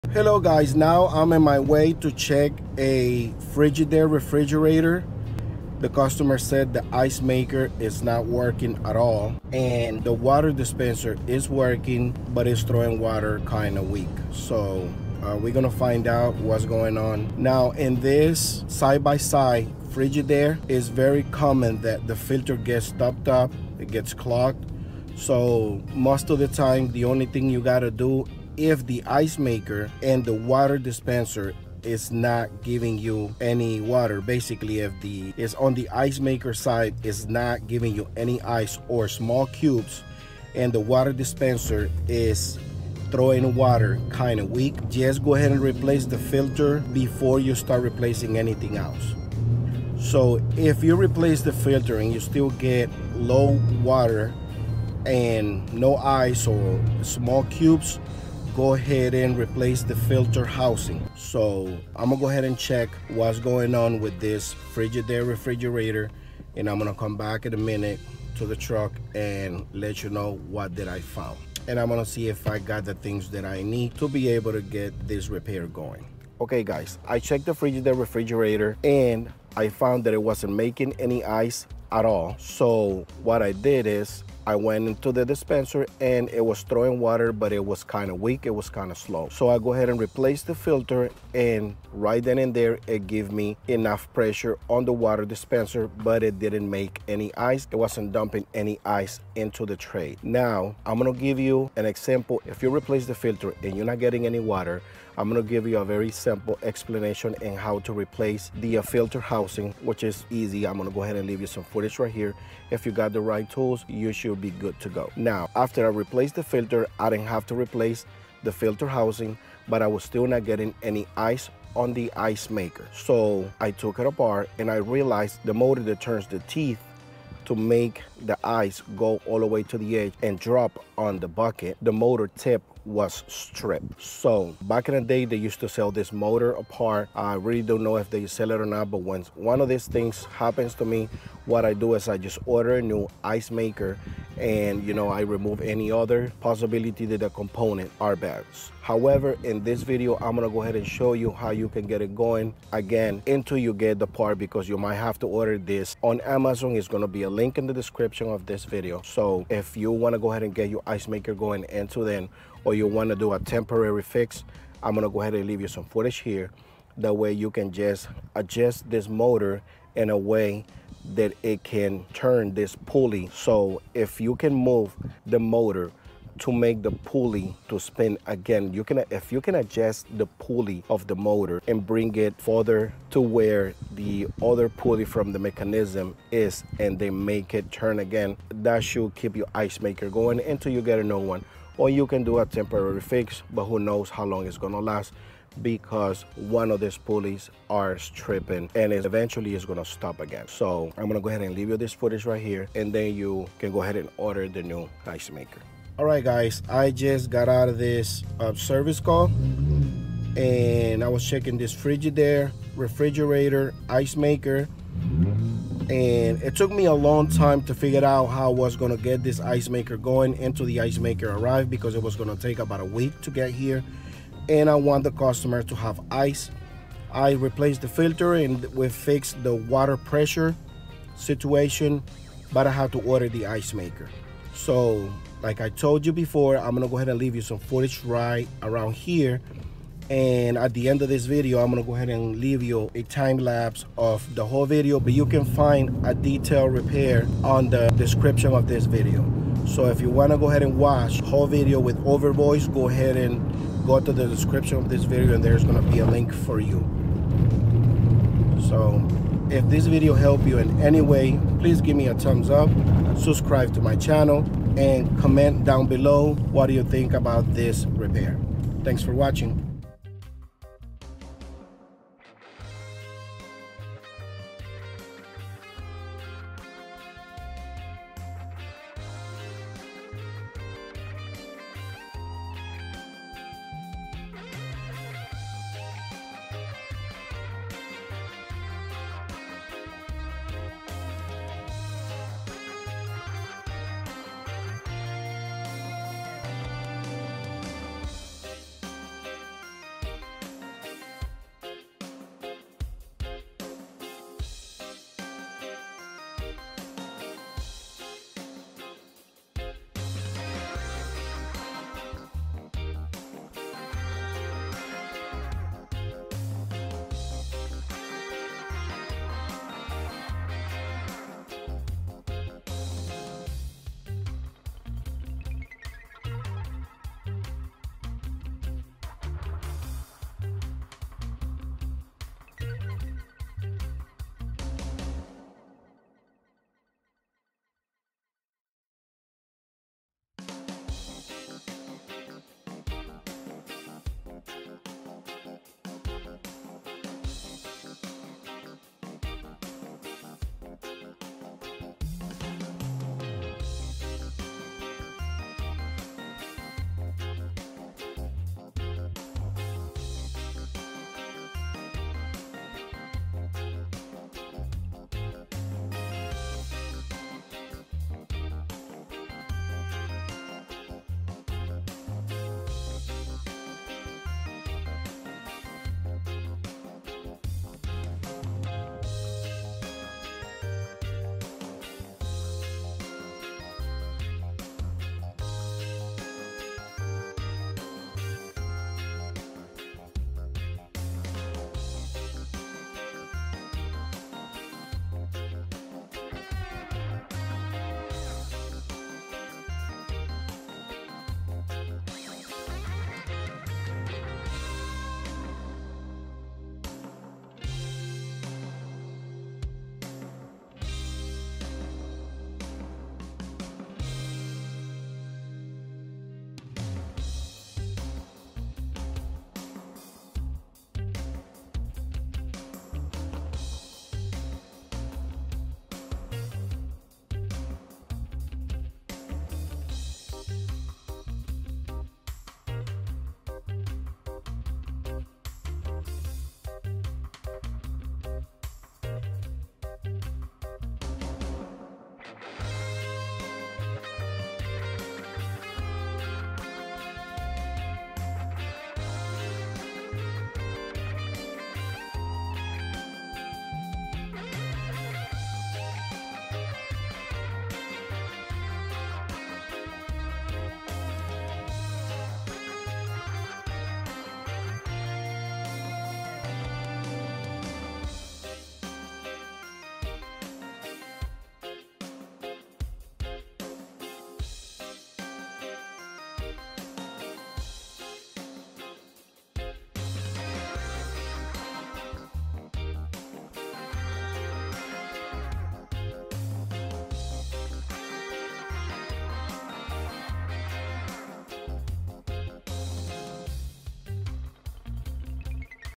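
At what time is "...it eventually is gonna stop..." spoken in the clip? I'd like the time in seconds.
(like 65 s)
198 s.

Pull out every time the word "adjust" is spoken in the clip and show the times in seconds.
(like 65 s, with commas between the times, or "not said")
168 s, 179 s.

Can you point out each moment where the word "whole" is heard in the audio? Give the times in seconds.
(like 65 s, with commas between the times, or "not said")
244 s, 251 s.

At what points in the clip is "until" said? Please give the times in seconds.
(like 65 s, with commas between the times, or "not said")
153 s, 161 s, 190 s, 220 s.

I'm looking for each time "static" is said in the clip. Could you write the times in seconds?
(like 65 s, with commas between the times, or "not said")
not said.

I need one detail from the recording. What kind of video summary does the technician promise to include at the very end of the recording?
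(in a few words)
time lapse.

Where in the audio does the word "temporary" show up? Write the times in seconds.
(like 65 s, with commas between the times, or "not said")
163 s, 192 s.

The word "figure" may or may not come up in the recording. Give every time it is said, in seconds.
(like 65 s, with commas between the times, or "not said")
217 s.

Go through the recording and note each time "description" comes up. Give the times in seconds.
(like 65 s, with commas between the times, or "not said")
157 s, 247 s, 254 s.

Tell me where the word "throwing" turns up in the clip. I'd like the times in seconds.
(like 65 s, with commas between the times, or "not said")
12 s, 43 s, 86 s.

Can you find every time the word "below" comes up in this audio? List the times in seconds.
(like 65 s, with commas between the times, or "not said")
265 s.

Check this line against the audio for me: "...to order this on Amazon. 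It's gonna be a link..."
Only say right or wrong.
right.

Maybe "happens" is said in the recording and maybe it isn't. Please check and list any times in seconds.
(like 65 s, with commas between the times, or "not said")
140 s.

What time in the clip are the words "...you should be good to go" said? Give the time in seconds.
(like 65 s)
113 s.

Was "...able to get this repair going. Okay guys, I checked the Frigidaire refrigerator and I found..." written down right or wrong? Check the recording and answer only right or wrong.
right.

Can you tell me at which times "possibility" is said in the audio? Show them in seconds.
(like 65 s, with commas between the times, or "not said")
146 s.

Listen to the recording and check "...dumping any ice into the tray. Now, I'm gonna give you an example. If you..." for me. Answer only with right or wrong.
right.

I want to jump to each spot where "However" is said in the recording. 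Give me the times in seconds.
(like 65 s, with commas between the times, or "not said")
148 s.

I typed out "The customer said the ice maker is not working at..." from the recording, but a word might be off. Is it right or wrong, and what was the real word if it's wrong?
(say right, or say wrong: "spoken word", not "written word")
right.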